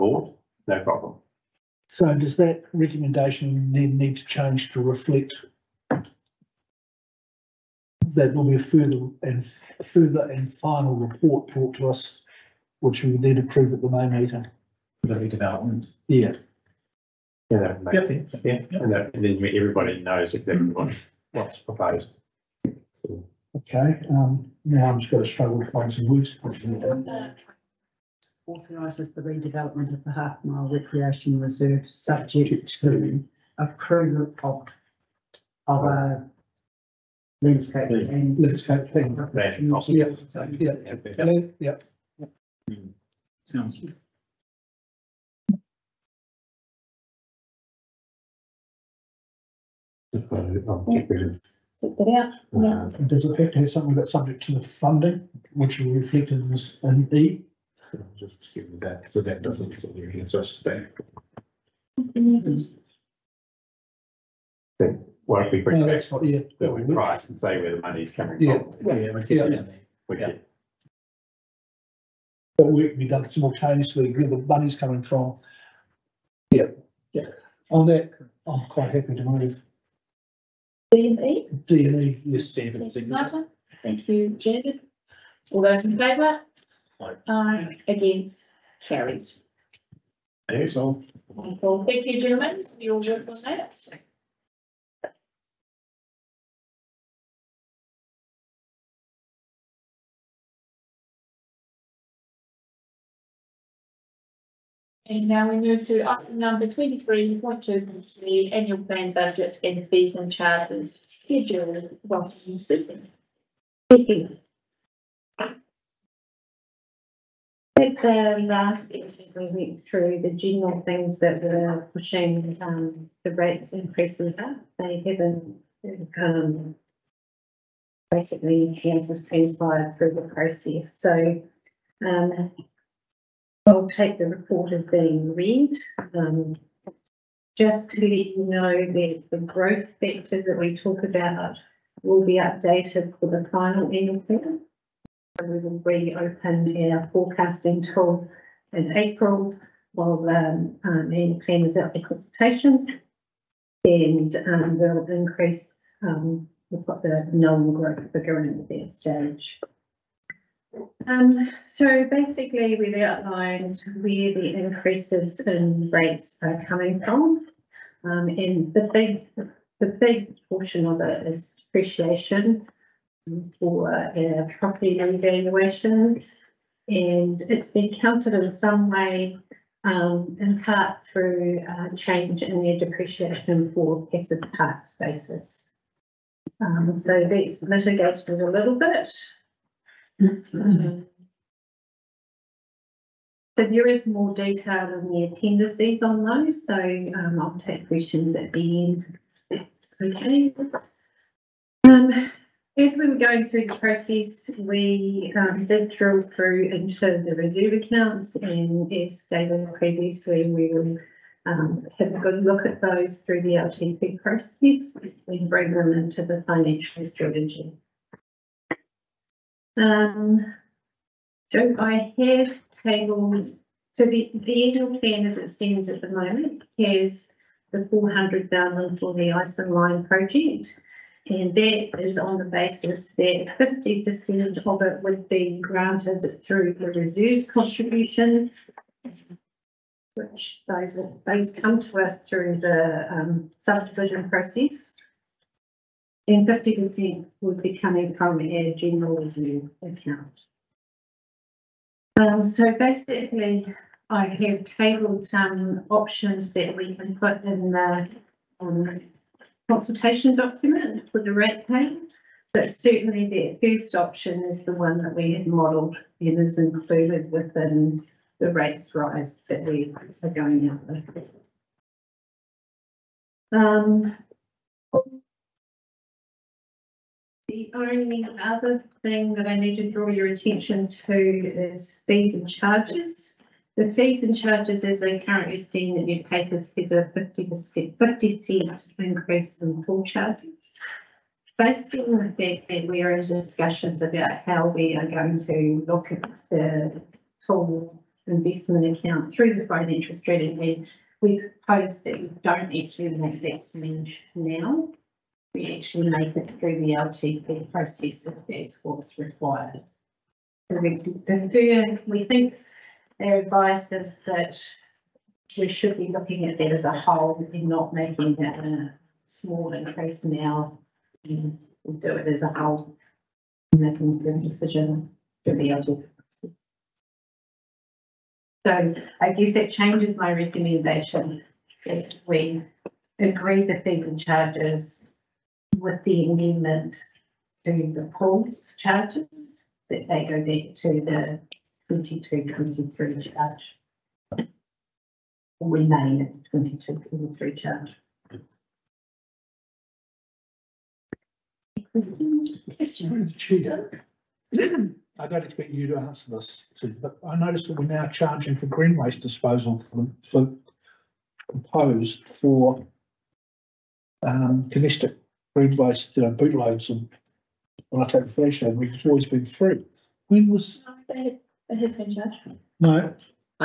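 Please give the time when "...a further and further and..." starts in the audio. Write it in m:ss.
0:08.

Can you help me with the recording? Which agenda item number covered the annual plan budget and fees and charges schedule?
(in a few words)
23.2.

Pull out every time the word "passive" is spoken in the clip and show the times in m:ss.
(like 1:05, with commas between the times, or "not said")
3:04.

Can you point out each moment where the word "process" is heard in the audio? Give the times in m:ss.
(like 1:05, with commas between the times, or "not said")
2:10, 3:23, 3:34, 4:04, 5:07, 5:25.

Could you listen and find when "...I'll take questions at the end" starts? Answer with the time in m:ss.
3:17.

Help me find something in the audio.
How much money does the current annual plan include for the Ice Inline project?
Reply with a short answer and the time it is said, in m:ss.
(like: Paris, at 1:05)
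400,000, at 3:47.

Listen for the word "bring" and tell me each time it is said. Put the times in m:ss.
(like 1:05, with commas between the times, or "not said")
1:05, 3:35.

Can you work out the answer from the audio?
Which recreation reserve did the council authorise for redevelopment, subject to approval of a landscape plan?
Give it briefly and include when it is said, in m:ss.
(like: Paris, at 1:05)
Half Mile, at 0:30.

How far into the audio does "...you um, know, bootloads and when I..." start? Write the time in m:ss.
6:06.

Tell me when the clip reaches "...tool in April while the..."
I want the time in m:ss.
2:27.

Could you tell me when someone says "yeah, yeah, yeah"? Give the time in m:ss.
0:40.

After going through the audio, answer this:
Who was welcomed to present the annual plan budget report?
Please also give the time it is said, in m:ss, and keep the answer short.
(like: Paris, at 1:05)
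Susan, at 1:52.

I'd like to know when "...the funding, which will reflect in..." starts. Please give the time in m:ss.
0:54.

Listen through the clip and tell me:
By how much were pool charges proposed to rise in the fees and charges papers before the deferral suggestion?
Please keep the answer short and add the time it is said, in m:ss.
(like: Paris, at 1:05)
50 cents, at 4:47.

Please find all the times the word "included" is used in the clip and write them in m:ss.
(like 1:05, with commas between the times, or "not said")
4:26.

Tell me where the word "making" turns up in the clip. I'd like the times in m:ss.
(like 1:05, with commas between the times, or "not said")
5:17, 5:23.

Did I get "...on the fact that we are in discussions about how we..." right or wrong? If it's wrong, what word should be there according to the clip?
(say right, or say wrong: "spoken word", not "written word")
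right.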